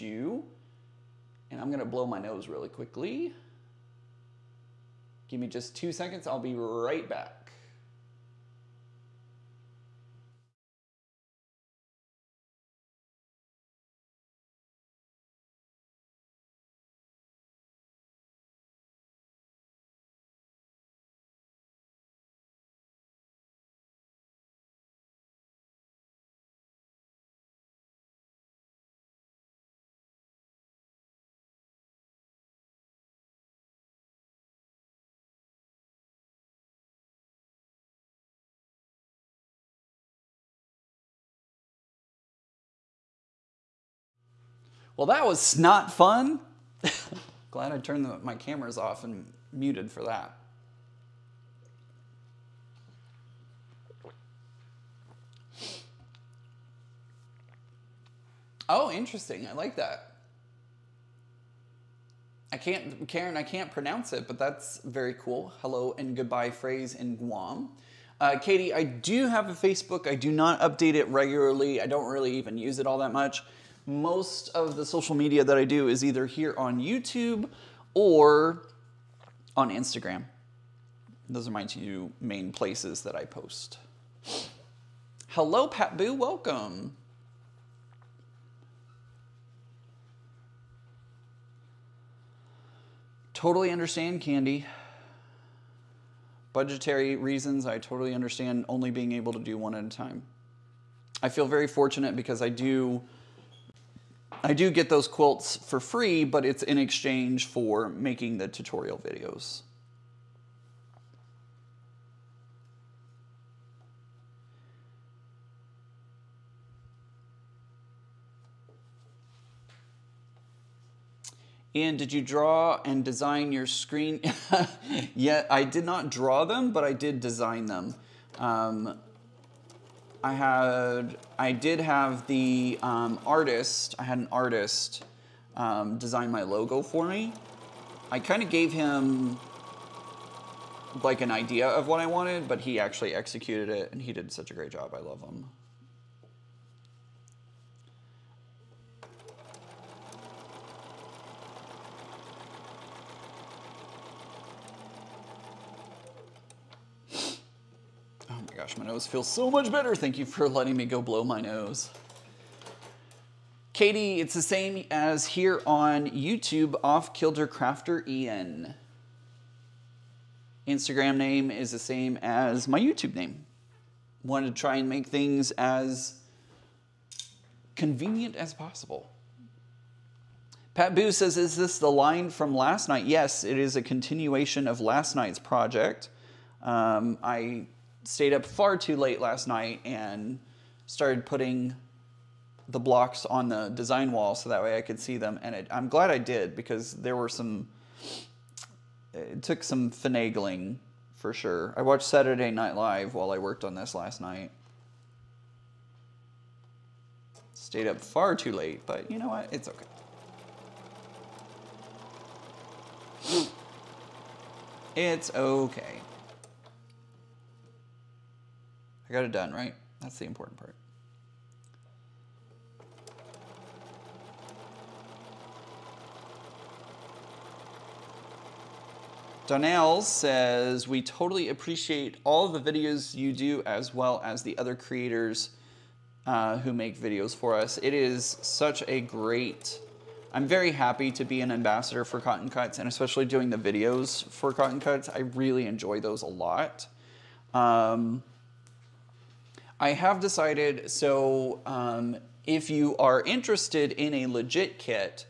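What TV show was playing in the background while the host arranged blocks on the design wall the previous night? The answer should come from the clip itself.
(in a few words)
Saturday Night Live.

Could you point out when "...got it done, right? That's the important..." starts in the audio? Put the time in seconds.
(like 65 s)
219 s.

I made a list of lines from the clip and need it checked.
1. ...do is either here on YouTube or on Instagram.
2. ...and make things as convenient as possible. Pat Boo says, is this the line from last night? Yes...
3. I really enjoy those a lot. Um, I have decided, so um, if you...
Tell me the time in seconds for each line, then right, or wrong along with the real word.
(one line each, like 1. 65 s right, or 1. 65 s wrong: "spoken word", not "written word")
1. 75 s right
2. 174 s right
3. 245 s right.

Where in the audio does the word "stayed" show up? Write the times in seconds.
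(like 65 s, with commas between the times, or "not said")
188 s, 207 s.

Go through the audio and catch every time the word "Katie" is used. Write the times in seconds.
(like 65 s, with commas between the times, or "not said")
68 s, 163 s.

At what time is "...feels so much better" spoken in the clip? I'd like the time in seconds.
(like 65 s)
159 s.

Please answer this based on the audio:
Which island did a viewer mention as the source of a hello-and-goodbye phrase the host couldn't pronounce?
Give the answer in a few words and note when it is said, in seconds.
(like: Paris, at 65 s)
Guam, at 67 s.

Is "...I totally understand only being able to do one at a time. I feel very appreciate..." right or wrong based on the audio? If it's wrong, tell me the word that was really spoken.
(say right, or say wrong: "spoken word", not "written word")
wrong: "fortunate", not "appreciate".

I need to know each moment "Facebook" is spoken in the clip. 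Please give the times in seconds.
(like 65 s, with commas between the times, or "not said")
69 s.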